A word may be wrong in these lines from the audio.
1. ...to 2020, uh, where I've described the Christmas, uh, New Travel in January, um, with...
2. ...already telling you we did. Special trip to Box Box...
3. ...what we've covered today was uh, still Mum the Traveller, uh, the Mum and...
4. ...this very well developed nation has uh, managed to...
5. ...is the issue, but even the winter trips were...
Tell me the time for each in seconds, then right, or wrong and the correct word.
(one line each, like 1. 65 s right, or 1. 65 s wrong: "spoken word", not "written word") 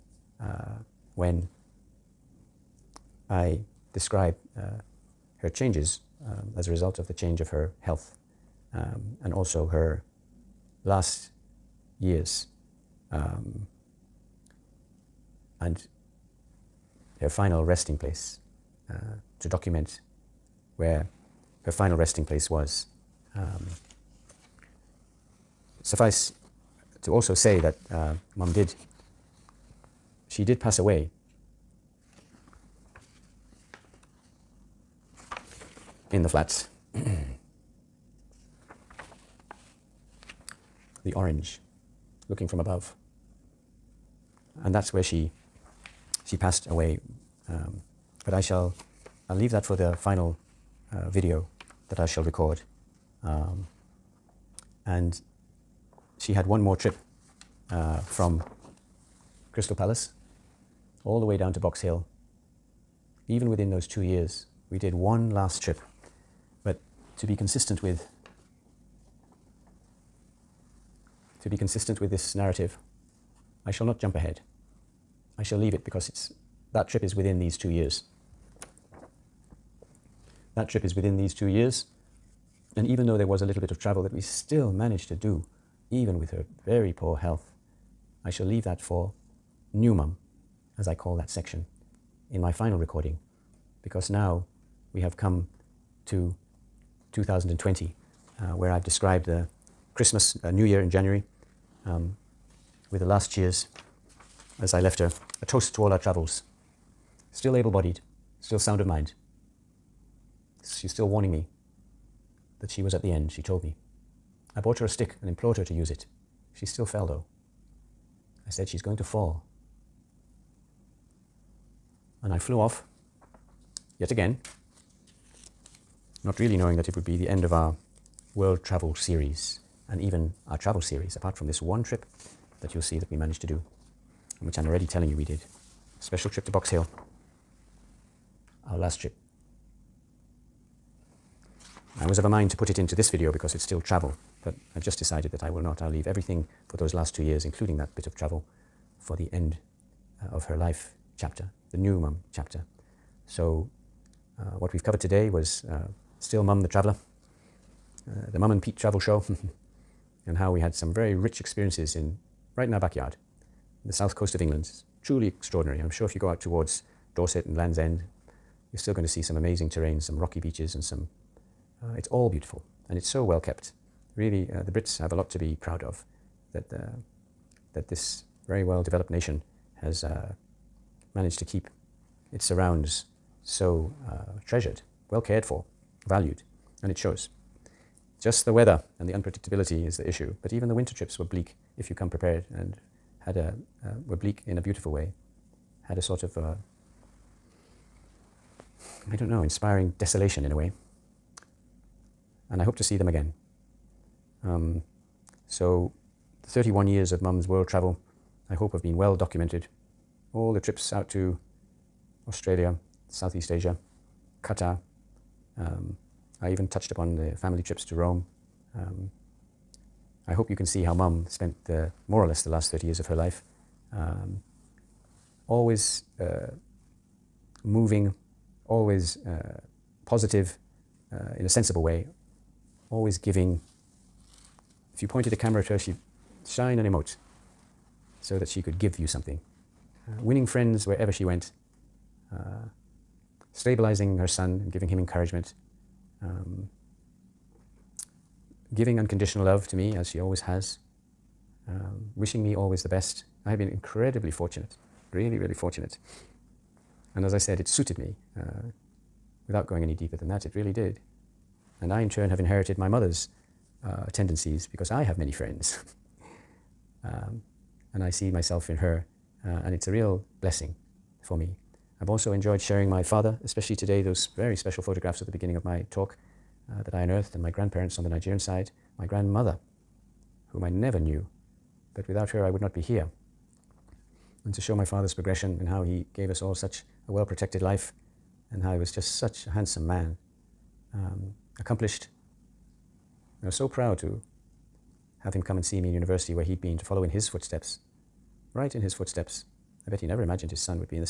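1. 96 s wrong: "Year", not "Travel"
2. 134 s wrong: "Hill", not "Box"
3. 154 s right
4. 177 s right
5. 189 s right.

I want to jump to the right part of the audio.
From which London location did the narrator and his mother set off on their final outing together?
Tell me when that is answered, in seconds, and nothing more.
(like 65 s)
59 s.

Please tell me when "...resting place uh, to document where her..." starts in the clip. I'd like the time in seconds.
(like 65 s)
17 s.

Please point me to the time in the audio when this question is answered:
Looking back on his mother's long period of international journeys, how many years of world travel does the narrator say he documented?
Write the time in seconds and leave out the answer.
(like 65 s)
206 s.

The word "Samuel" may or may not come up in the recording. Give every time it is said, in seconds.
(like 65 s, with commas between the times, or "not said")
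not said.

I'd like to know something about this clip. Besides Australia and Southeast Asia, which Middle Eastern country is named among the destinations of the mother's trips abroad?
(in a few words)
Qatar.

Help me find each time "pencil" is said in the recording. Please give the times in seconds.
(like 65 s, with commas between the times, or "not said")
not said.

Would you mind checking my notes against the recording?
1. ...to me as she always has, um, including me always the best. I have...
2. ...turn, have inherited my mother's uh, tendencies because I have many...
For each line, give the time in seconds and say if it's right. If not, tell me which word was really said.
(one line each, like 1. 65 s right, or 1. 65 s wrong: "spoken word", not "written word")
1. 249 s wrong: "wishing", not "including"
2. 262 s right.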